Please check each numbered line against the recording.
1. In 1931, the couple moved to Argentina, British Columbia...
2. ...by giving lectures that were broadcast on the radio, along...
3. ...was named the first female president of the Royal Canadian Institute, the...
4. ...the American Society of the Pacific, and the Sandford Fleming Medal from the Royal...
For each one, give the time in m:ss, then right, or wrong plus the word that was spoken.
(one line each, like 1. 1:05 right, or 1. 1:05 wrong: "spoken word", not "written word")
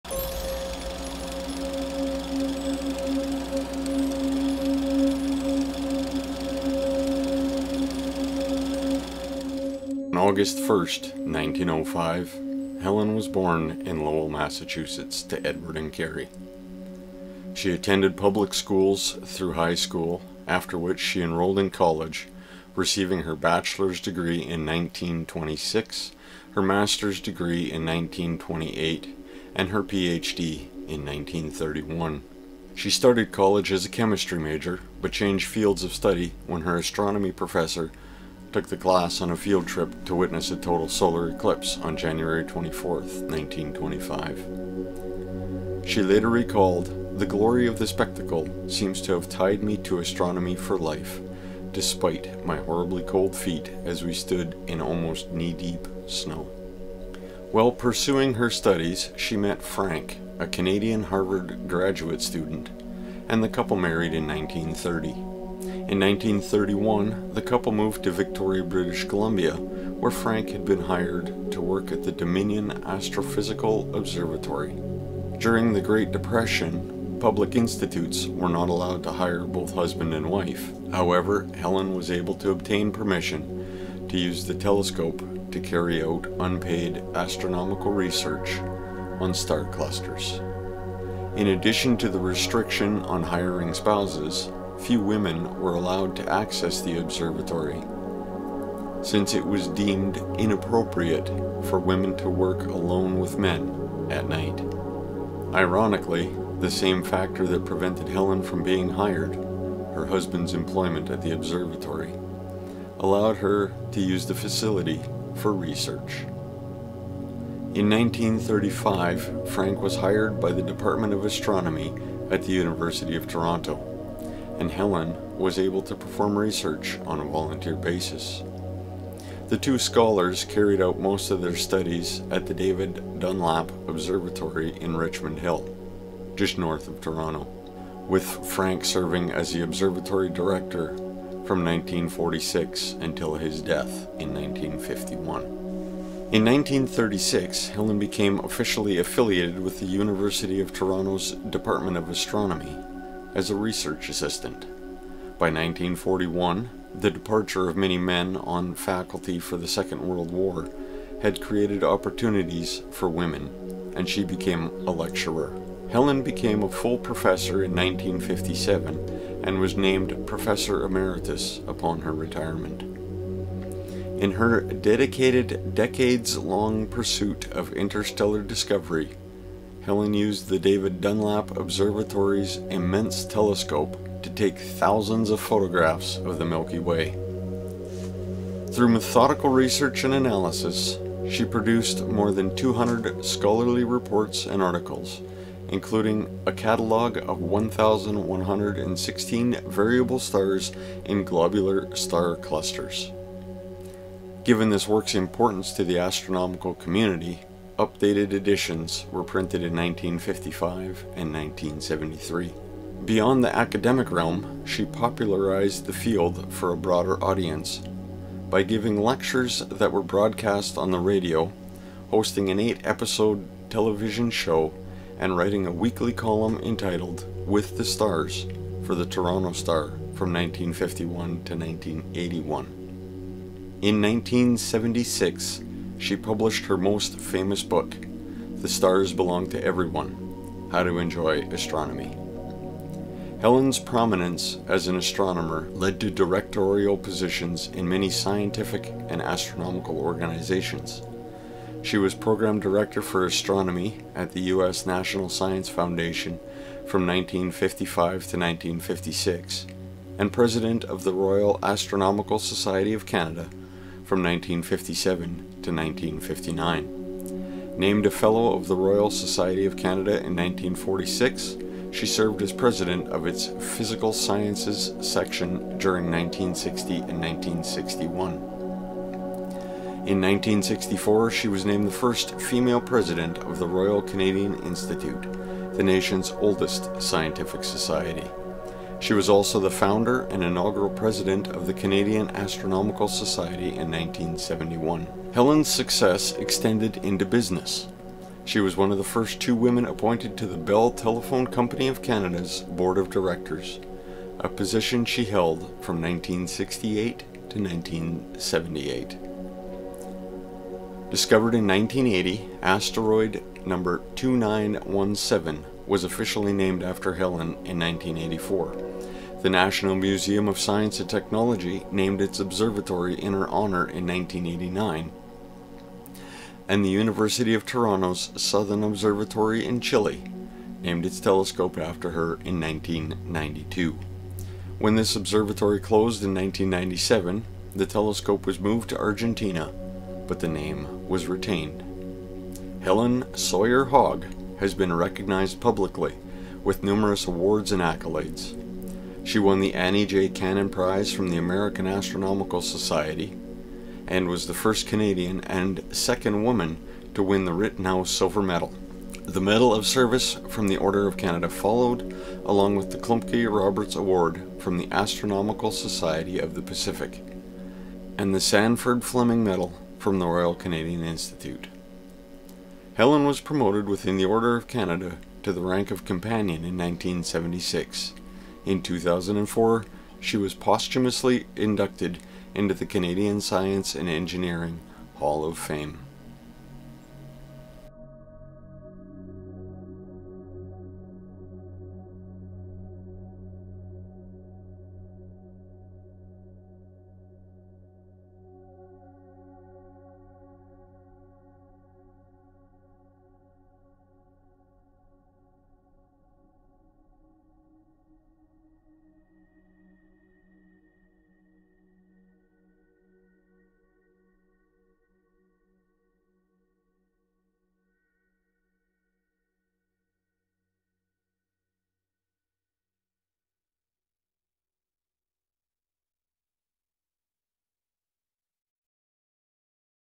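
1. 1:05 wrong: "Victoria", not "Argentina"
2. 3:38 wrong: "hosting", not "along"
3. 4:41 right
4. 6:04 wrong: "Astronomical", not "American".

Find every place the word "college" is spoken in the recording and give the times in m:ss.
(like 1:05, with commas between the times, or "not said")
0:21, 0:33.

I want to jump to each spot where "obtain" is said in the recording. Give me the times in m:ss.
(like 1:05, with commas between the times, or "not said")
1:22.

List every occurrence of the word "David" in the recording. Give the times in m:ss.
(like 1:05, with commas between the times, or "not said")
2:12, 3:00.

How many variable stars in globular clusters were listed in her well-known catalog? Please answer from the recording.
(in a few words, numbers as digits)
1,116.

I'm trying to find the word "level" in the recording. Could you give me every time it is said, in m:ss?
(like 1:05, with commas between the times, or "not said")
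not said.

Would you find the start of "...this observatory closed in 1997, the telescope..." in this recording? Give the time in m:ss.
5:34.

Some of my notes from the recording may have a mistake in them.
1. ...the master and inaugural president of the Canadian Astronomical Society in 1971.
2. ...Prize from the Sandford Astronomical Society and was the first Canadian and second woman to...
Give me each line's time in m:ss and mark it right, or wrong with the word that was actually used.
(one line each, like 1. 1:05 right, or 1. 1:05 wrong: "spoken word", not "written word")
1. 4:49 wrong: "founder", not "master"
2. 5:50 wrong: "American", not "Sandford".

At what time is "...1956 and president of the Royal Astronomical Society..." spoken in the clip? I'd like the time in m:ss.
4:18.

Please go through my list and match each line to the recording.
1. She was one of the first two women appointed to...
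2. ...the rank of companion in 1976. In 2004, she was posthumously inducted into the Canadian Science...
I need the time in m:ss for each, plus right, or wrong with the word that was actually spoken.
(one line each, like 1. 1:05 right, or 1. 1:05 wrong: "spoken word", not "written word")
1. 4:58 right
2. 6:15 right.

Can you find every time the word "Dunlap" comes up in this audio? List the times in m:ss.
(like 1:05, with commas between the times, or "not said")
2:13, 3:01.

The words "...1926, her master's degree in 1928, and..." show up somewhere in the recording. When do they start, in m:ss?
0:24.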